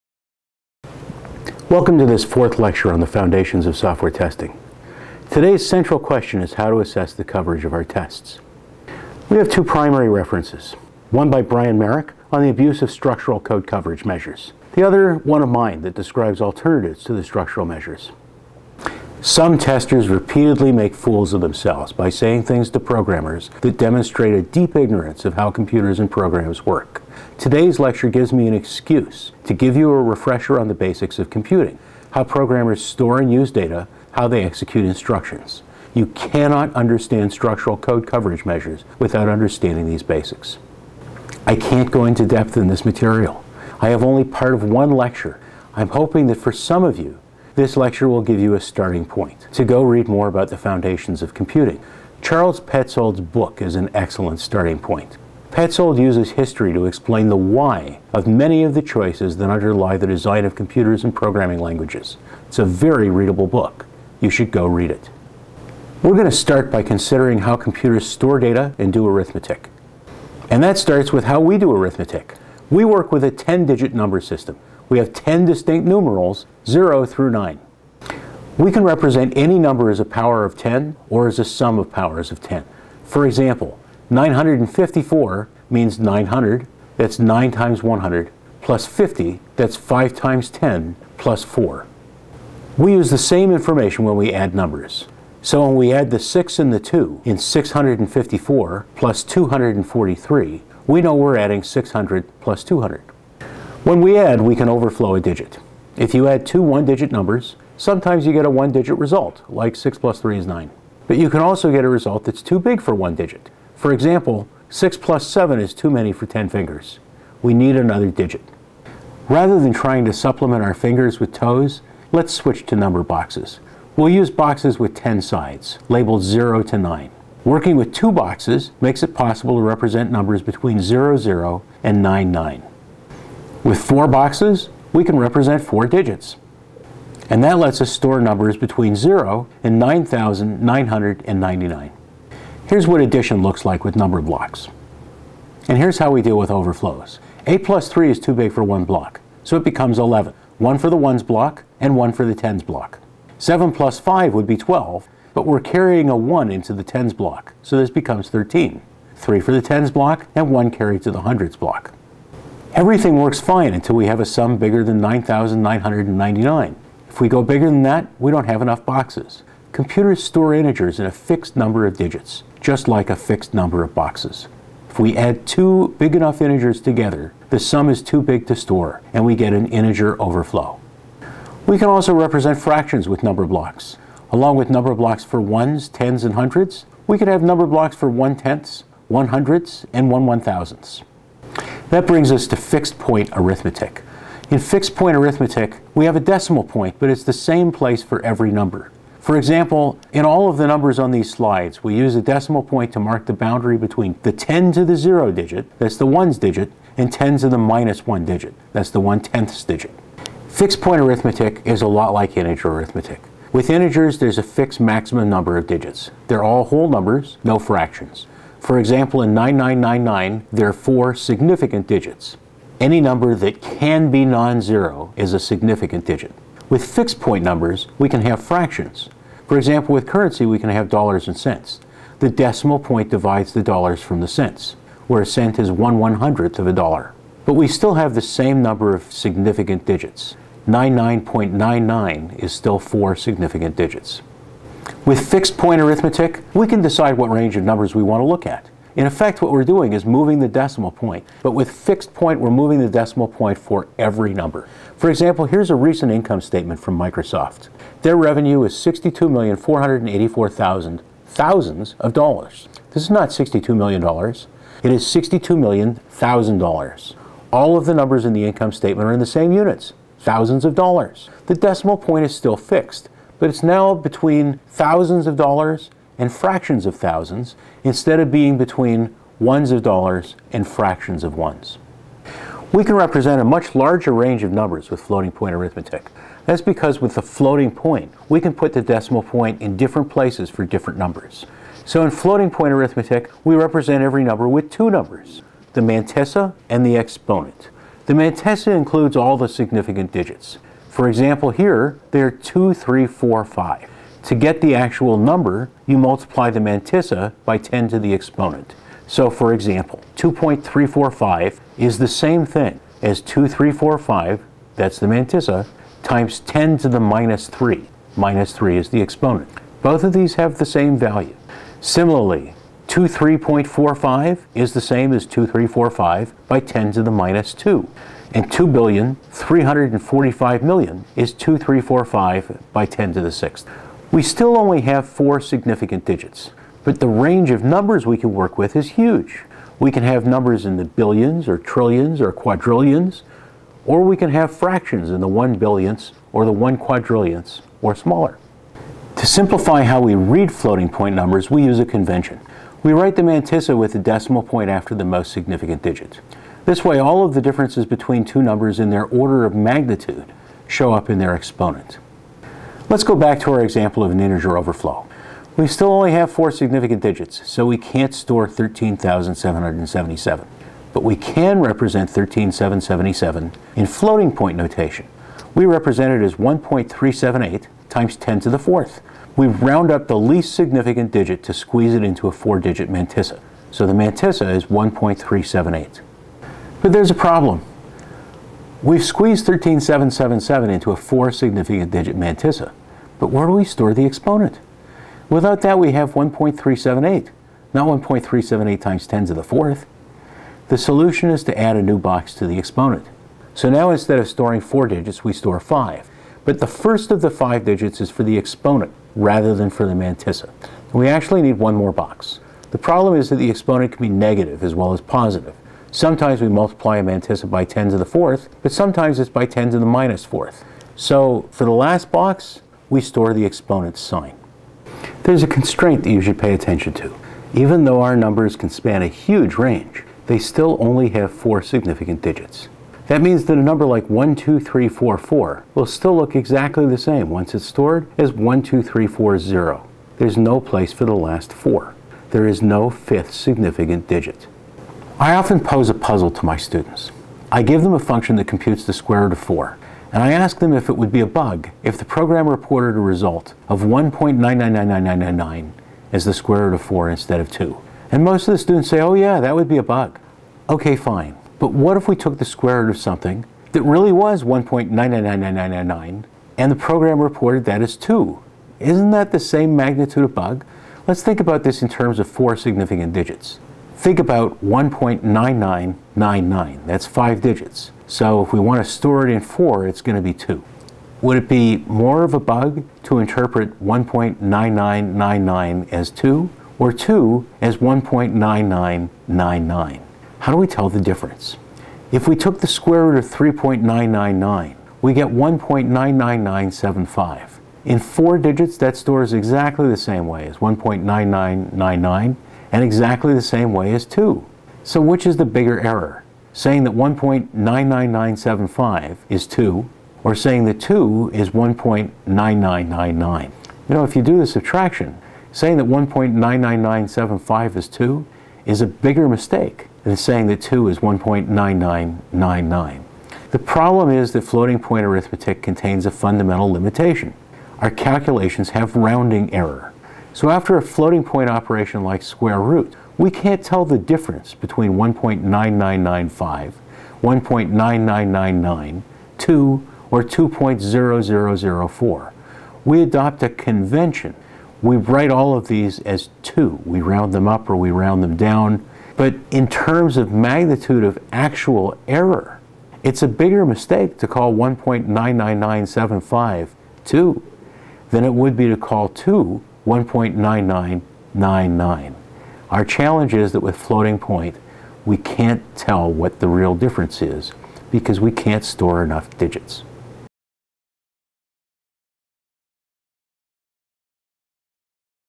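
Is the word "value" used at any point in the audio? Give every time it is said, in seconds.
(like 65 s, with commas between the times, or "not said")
320 s.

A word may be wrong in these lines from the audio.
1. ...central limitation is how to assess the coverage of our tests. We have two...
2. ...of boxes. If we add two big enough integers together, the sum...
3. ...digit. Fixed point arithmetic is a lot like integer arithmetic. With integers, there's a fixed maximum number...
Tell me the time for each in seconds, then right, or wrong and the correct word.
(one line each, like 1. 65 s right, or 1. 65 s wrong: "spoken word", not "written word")
1. 5 s wrong: "question", not "limitation"
2. 173 s right
3. 209 s right.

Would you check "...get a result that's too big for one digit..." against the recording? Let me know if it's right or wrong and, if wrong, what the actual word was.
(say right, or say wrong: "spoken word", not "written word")
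right.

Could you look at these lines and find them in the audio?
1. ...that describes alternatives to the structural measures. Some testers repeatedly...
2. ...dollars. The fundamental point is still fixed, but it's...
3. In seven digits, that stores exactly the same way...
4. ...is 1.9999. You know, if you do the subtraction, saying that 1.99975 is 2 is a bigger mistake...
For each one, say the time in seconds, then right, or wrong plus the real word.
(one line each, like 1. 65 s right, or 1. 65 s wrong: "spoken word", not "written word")
1. 15 s right
2. 270 s wrong: "decimal", not "fundamental"
3. 497 s wrong: "four", not "seven"
4. 511 s right.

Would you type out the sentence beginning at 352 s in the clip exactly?
We write the mantissa with the decimal point after the most significant digit.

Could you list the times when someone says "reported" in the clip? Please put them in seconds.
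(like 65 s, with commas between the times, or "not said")
452 s, 467 s.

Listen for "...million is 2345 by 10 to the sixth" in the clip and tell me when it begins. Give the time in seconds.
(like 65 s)
330 s.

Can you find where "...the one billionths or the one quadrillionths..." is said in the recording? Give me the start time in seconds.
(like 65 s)
345 s.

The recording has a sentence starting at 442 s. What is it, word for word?
There is no fifth significant digit.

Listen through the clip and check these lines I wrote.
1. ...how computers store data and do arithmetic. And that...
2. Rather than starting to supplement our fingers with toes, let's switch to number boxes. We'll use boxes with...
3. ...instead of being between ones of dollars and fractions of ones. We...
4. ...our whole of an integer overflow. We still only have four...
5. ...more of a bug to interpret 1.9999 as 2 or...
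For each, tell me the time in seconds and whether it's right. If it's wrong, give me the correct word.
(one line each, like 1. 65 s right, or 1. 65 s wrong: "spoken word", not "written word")
1. 67 s right
2. 119 s wrong: "trying", not "starting"
3. 277 s right
4. 363 s wrong: "example", not "whole"
5. 481 s right.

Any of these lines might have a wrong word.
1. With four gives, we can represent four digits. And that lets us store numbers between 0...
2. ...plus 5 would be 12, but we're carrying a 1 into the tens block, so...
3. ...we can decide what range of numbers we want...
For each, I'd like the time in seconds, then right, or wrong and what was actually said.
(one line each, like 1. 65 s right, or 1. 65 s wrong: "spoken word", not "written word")
1. 133 s wrong: "boxes", not "gives"
2. 153 s right
3. 246 s right.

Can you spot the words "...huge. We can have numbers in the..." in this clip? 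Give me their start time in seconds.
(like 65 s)
338 s.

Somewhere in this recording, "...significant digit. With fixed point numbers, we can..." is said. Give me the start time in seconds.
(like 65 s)
225 s.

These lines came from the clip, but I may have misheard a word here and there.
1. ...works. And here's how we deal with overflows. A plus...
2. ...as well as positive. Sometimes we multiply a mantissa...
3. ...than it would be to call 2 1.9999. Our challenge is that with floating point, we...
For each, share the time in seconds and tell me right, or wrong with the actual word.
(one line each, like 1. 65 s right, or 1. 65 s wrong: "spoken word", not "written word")
1. 144 s wrong: "blocks", not "works"
2. 414 s right
3. 558 s right.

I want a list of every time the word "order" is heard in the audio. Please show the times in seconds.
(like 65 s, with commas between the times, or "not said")
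359 s.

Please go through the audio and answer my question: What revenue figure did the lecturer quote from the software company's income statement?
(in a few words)
62,484,000.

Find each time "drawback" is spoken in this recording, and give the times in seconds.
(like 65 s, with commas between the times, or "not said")
not said.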